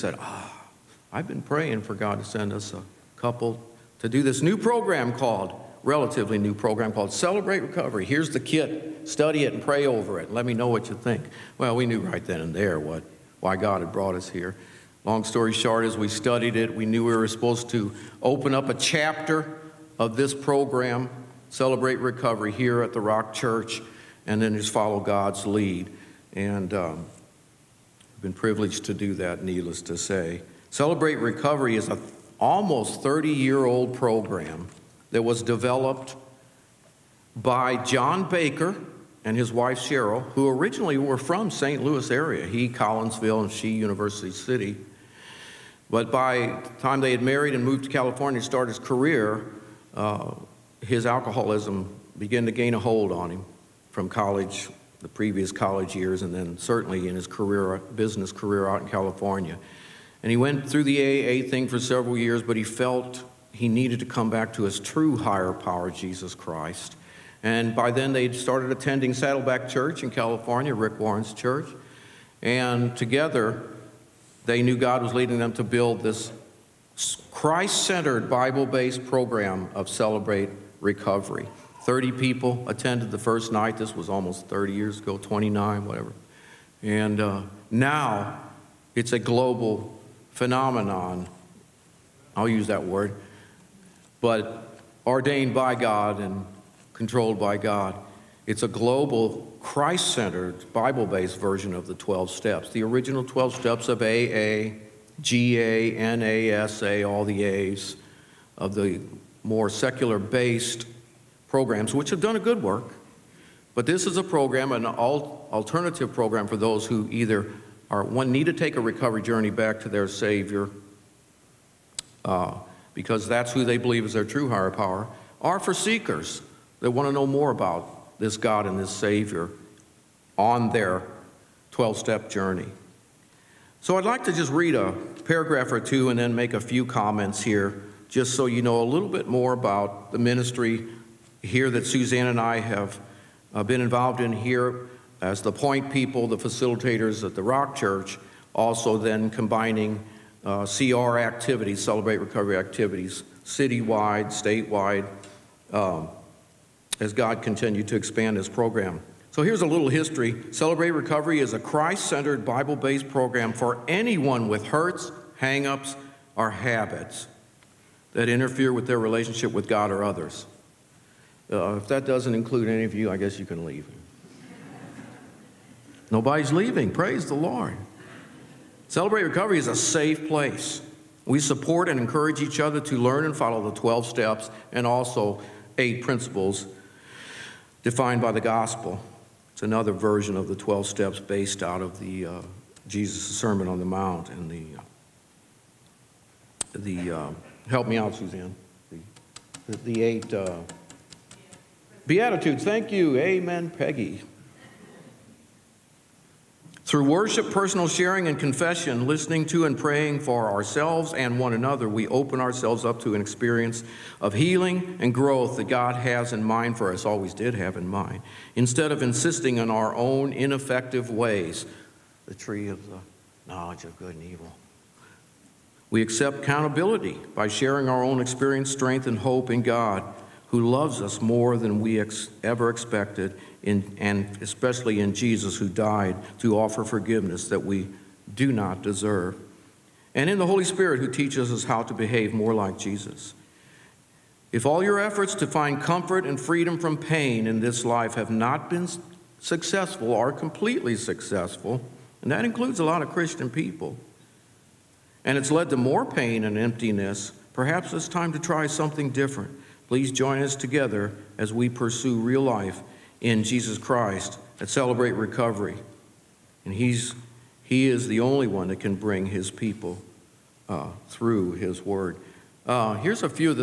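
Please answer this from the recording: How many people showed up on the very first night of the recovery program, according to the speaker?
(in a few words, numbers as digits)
30.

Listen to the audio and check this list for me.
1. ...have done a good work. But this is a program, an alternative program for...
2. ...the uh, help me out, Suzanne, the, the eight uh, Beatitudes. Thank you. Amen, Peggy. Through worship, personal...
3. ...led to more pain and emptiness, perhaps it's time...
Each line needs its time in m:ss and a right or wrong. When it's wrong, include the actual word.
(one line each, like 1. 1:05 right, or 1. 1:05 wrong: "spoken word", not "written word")
1. 1:52 right
2. 3:16 right
3. 4:15 right.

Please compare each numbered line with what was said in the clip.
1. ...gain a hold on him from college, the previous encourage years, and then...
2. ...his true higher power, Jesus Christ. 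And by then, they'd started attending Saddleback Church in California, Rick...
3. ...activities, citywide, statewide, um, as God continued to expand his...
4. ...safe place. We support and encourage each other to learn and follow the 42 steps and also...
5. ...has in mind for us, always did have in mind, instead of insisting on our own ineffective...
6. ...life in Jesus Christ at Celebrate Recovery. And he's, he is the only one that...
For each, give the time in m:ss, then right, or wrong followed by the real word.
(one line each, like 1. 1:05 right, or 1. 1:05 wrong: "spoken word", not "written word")
1. 0:52 wrong: "college", not "encourage"
2. 1:04 right
3. 2:32 right
4. 2:59 wrong: "12", not "42"
5. 3:35 right
6. 4:22 right.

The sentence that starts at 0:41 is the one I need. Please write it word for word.
Louis area, he Collinsville and she University City.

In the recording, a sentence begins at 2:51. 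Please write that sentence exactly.
Uh, if that doesn't include any of you, I guess you can leave.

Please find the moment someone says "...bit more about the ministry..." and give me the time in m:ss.
2:19.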